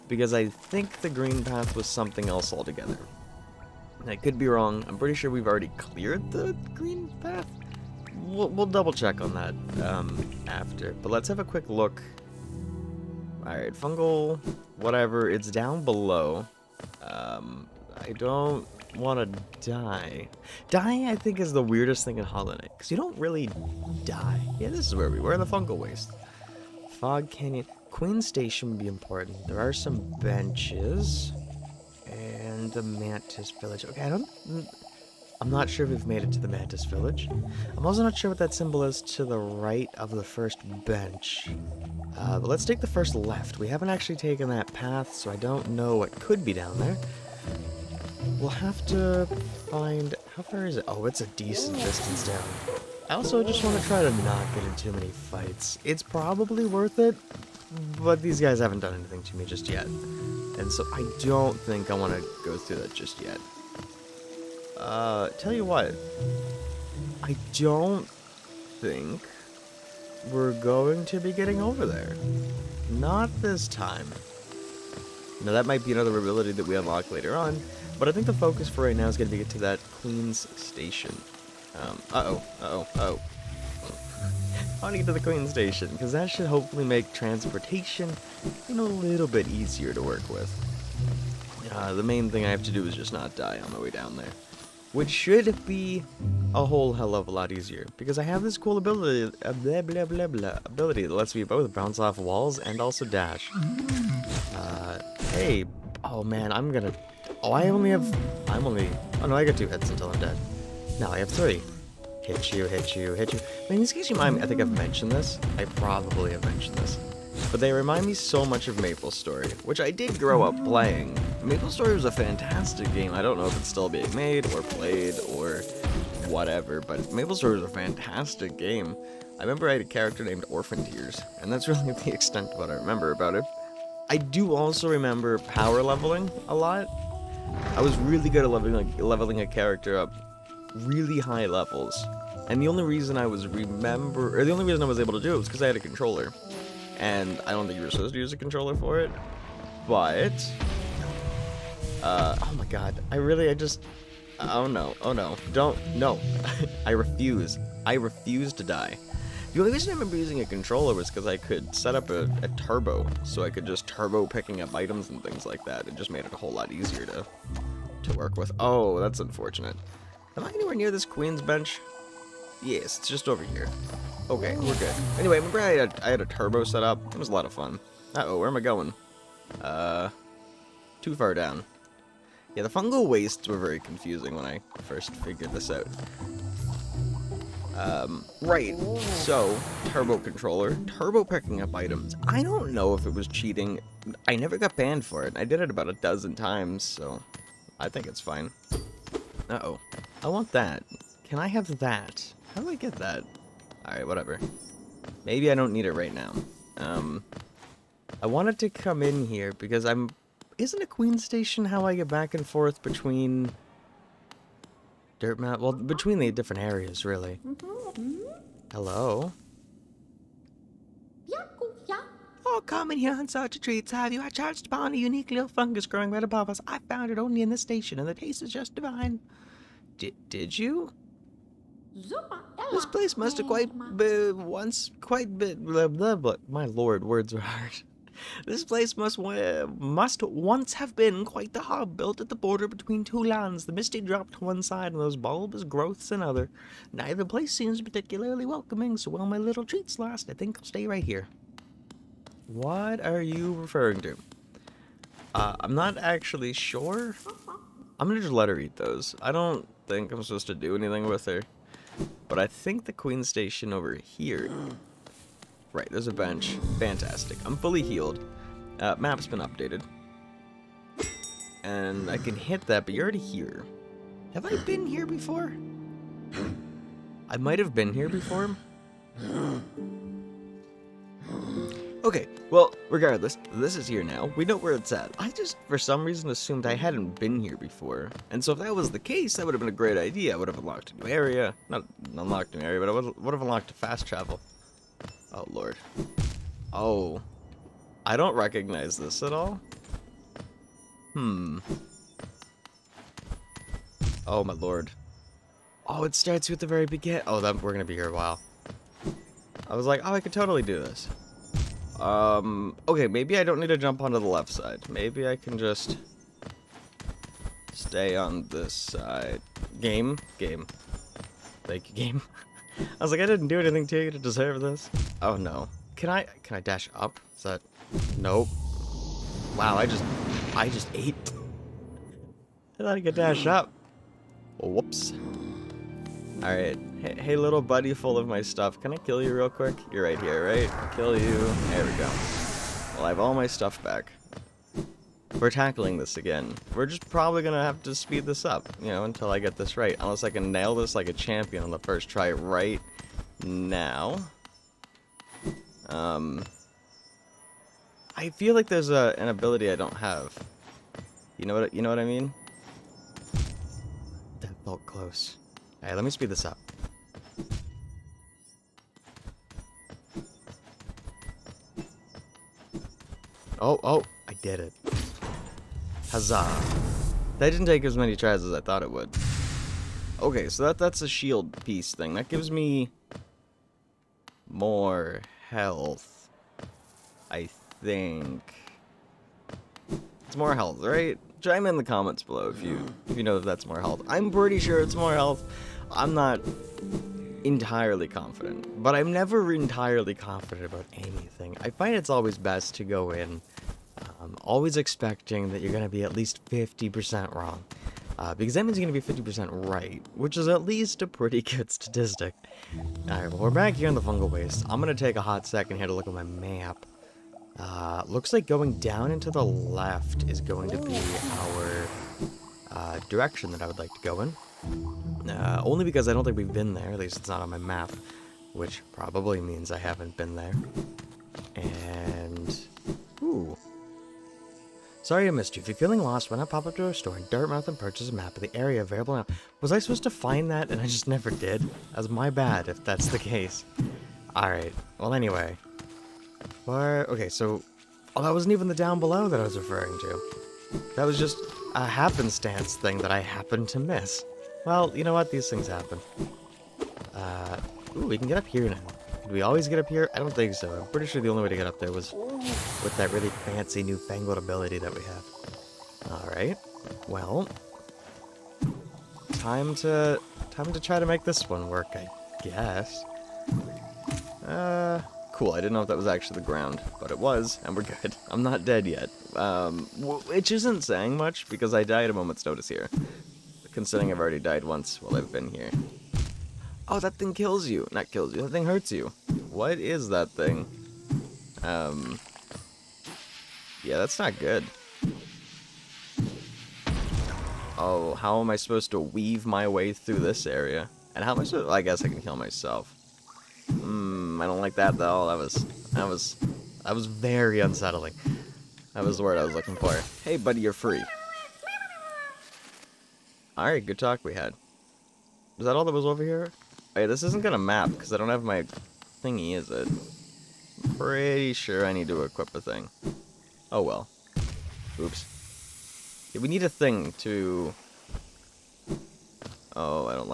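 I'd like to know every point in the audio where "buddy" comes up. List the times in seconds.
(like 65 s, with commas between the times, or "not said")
337 s, 510 s.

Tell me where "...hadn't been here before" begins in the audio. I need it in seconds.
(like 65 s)
286 s.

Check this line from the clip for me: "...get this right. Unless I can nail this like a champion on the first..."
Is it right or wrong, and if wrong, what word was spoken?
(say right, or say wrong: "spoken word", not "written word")
right.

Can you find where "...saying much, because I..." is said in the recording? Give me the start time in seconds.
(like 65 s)
480 s.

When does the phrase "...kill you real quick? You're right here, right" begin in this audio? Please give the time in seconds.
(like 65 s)
338 s.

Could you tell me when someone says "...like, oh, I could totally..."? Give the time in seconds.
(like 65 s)
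309 s.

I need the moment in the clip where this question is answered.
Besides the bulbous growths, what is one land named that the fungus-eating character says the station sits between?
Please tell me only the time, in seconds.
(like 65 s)
243 s.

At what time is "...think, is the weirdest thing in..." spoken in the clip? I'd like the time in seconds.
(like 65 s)
21 s.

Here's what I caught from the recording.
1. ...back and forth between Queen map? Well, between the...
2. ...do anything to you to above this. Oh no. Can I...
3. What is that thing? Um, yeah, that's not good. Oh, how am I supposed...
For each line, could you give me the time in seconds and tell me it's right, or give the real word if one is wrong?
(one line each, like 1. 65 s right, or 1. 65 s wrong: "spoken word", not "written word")
1. 212 s wrong: "Dirt", not "Queen"
2. 323 s wrong: "deserve", not "above"
3. 489 s right.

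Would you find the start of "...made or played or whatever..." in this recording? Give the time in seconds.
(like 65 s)
124 s.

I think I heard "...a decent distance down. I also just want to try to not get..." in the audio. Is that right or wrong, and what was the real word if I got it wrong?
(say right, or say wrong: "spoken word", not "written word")
right.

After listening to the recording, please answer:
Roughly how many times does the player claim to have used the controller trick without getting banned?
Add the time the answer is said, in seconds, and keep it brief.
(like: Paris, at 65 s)
a dozen, at 195 s.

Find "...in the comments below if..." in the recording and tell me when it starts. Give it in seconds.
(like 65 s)
391 s.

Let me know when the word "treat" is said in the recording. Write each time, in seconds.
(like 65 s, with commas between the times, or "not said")
223 s, 249 s.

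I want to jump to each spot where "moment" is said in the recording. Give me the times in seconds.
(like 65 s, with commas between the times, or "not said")
482 s.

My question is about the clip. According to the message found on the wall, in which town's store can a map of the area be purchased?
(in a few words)
Dirtmouth.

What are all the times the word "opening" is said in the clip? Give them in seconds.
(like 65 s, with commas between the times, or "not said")
not said.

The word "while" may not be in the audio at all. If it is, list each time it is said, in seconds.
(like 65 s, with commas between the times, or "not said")
249 s, 308 s, 485 s.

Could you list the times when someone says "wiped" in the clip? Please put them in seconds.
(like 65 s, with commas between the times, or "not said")
not said.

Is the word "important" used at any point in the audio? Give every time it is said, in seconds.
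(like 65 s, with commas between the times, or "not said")
28 s.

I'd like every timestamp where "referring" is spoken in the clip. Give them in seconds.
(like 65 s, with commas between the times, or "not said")
253 s, 449 s.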